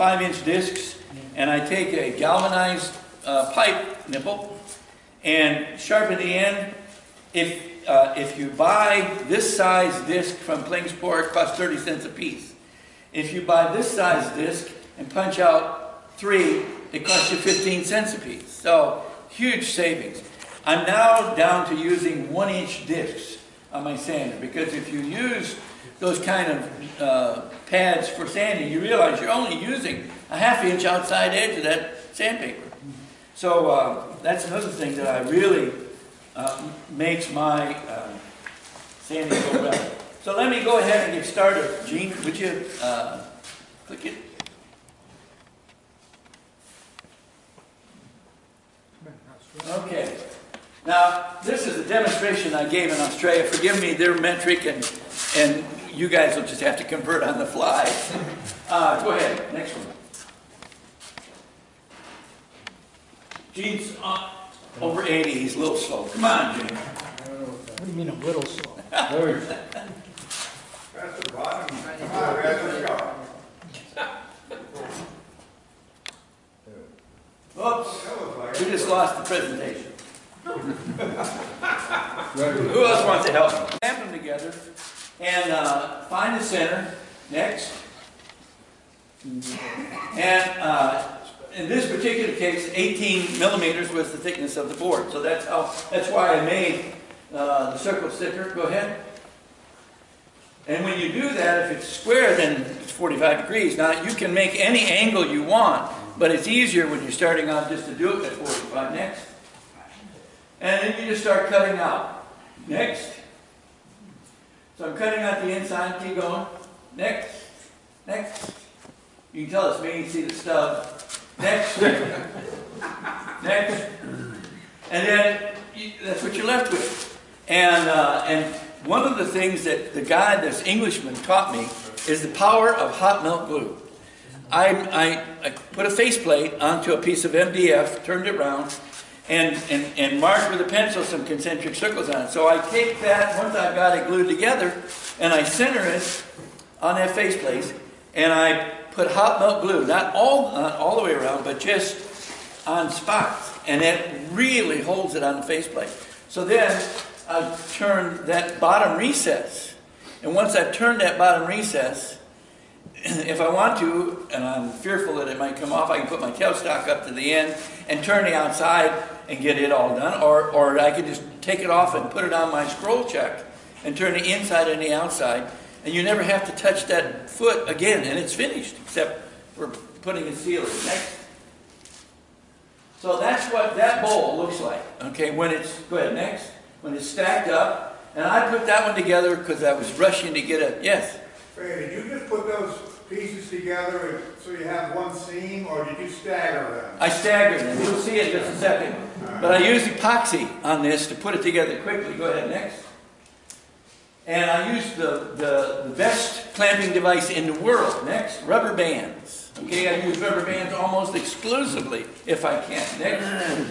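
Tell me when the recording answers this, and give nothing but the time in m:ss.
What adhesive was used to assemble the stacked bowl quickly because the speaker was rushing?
3:19.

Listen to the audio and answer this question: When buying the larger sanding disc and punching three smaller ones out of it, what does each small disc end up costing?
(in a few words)
15 cents.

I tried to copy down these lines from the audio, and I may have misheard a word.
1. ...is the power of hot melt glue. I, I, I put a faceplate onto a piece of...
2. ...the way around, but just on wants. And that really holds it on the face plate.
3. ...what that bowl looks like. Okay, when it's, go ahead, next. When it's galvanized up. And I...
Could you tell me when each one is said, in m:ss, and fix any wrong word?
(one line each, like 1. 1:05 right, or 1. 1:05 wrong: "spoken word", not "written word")
1. 2:12 right
2. 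2:30 wrong: "spots", not "wants"
3. 3:03 wrong: "stacked", not "galvanized".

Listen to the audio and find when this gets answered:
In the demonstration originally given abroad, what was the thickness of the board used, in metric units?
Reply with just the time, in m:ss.
1:32.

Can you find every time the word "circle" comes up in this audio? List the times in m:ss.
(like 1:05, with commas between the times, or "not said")
1:37, 2:21.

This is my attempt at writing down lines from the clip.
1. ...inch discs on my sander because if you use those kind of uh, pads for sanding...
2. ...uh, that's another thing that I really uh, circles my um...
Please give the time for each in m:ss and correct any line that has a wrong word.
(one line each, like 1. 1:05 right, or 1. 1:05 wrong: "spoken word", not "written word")
1. 0:22 right
2. 0:33 wrong: "makes", not "circles".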